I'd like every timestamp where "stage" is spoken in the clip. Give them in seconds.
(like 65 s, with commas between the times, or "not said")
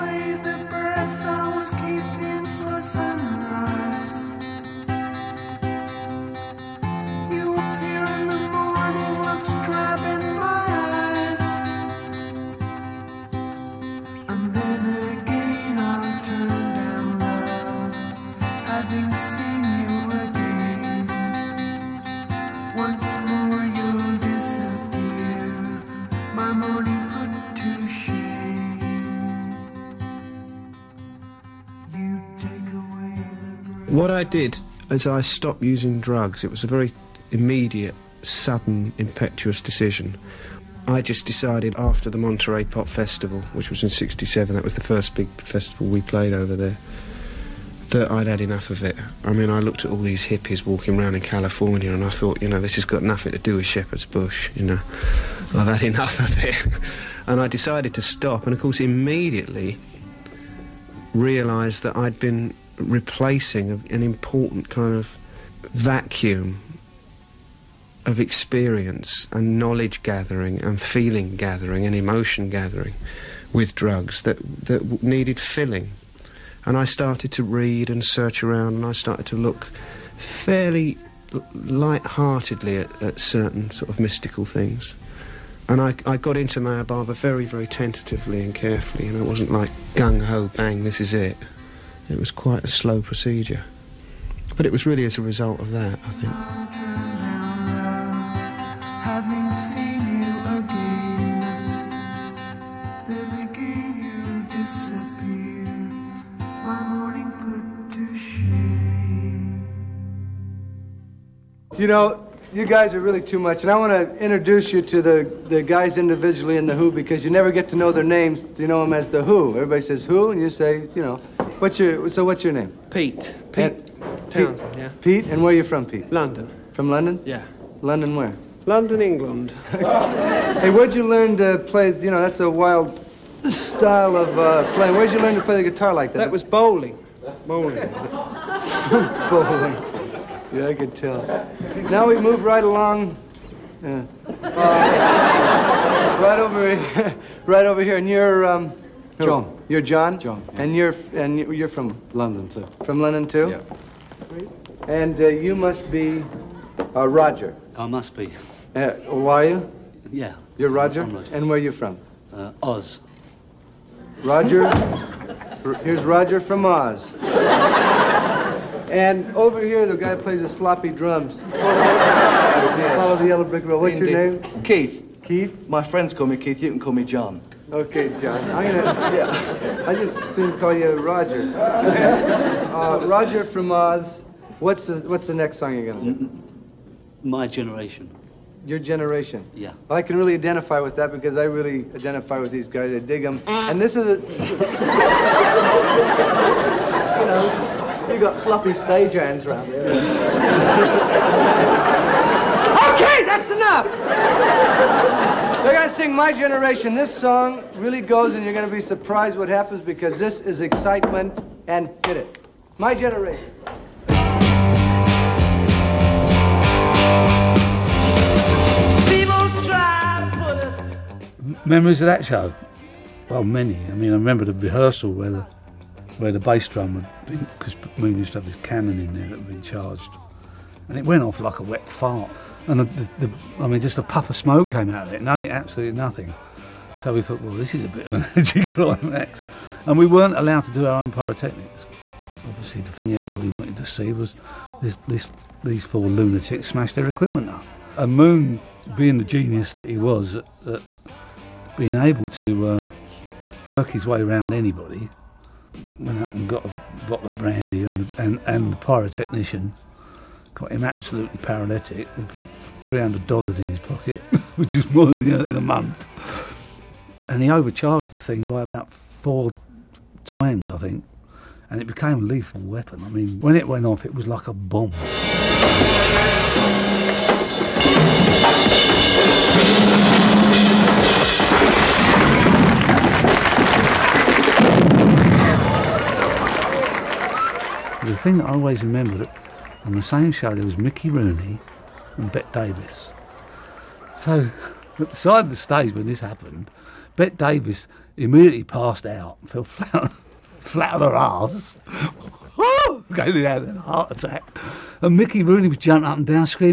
198 s, 295 s.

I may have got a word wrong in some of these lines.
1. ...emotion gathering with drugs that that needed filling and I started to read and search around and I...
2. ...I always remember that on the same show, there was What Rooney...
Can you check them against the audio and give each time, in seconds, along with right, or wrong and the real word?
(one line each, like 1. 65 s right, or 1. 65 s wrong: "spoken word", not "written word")
1. 71 s right
2. 288 s wrong: "Mickey", not "What".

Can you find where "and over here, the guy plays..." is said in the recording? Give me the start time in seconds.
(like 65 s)
168 s.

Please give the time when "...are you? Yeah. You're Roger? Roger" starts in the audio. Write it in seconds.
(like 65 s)
159 s.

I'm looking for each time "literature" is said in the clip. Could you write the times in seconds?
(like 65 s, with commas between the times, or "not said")
not said.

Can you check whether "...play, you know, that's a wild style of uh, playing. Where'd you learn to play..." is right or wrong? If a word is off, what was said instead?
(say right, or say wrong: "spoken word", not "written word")
right.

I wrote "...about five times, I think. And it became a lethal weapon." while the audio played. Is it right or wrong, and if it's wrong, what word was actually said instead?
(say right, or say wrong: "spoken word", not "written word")
wrong: "four", not "five".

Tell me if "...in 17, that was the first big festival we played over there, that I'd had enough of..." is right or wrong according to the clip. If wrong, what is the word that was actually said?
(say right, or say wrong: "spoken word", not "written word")
wrong: "67", not "17".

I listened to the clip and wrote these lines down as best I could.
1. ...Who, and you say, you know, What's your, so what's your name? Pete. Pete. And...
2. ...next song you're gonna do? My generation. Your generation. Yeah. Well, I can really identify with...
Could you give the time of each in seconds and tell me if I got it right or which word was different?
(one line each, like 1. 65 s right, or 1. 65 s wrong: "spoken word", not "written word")
1. 120 s right
2. 185 s right.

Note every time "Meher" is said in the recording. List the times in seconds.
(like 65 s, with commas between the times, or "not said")
86 s.